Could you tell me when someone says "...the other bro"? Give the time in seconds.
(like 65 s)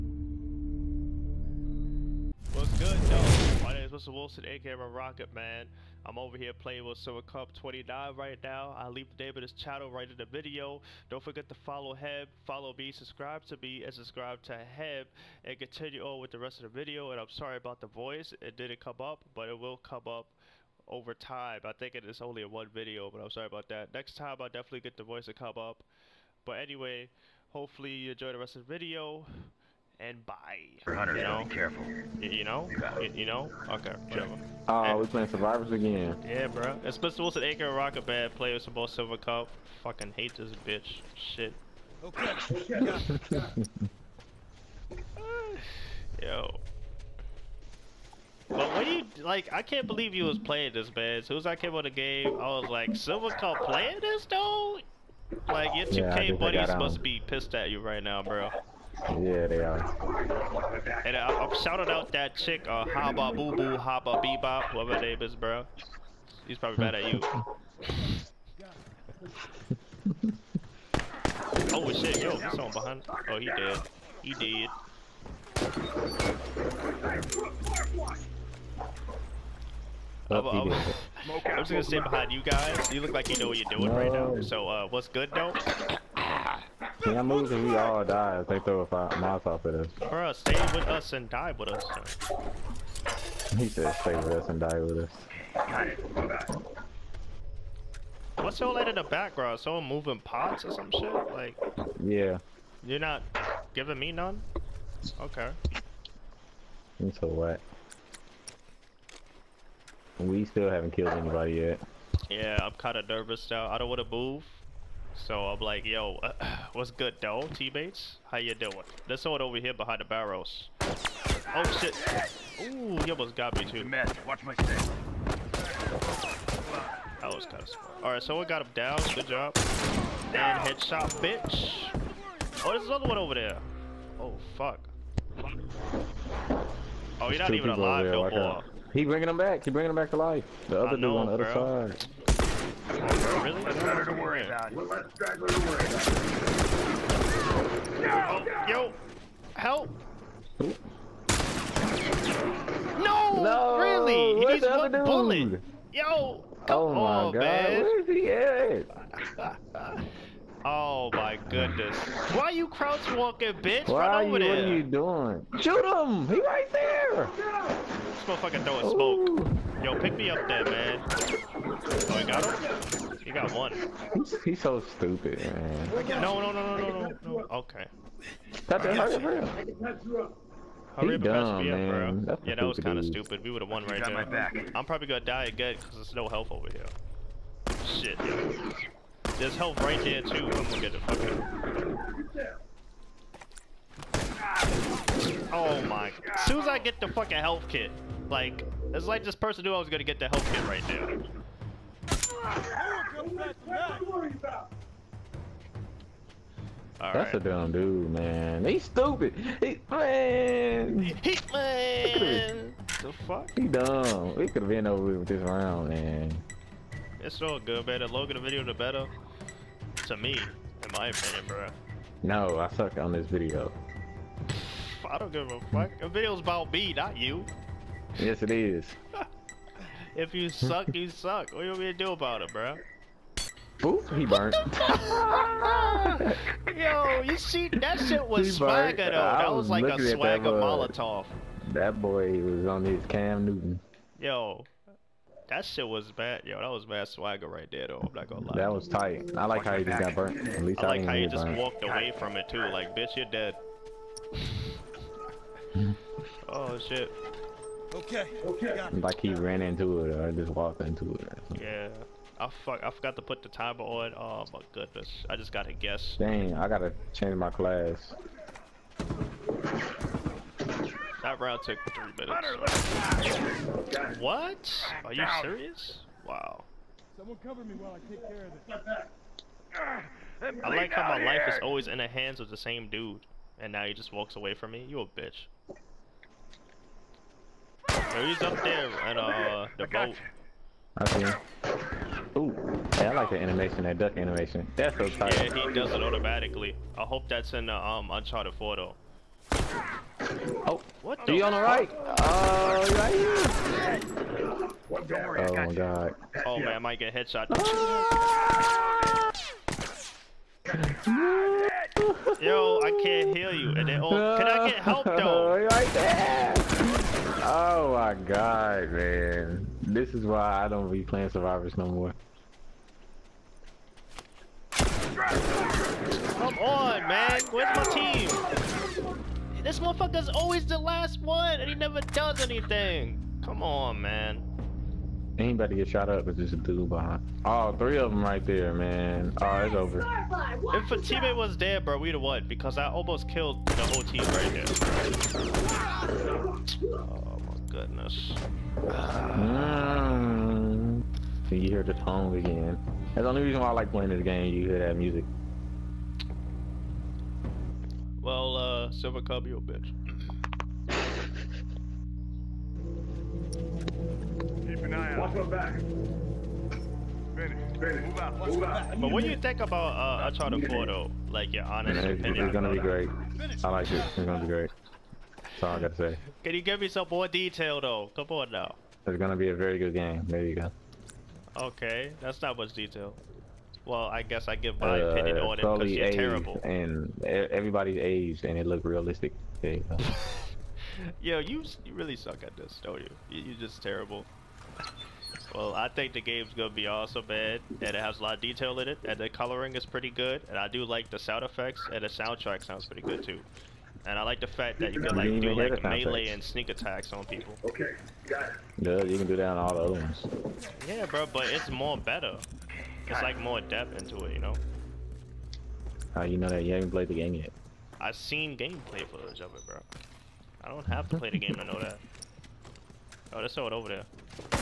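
141 s.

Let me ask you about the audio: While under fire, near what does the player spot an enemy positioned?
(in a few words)
the boat.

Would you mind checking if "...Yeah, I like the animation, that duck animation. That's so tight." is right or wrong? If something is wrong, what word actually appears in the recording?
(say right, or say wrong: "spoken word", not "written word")
right.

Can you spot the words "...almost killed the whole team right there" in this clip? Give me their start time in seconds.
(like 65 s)
342 s.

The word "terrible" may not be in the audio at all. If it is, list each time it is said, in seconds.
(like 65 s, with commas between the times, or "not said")
386 s, 393 s.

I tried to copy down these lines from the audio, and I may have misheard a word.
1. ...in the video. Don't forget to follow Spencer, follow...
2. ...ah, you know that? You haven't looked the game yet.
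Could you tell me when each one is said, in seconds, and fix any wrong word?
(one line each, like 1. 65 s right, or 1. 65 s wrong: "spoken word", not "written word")
1. 10 s wrong: "Heb", not "Spencer"
2. 416 s wrong: "played", not "looked".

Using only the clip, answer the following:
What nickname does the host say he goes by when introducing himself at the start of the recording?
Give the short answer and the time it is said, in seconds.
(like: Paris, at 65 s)
Rocket Man, at 4 s.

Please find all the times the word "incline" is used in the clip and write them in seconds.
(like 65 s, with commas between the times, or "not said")
not said.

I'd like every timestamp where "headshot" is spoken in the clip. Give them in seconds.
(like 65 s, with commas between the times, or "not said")
130 s, 307 s.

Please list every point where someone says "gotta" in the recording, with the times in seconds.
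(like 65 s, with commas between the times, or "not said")
266 s, 375 s.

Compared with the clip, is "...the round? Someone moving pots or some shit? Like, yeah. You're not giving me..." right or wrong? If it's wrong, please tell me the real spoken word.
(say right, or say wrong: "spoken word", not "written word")
wrong: "background", not "round".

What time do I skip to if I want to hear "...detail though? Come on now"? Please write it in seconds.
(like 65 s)
377 s.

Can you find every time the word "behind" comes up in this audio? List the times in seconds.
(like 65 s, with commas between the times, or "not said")
72 s, 81 s, 119 s, 336 s.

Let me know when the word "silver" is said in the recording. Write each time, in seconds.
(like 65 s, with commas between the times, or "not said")
6 s, 38 s, 52 s, 358 s.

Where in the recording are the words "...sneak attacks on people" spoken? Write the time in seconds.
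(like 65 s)
406 s.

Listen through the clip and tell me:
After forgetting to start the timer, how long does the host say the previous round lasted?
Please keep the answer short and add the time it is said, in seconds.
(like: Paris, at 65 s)
Three minutes, at 271 s.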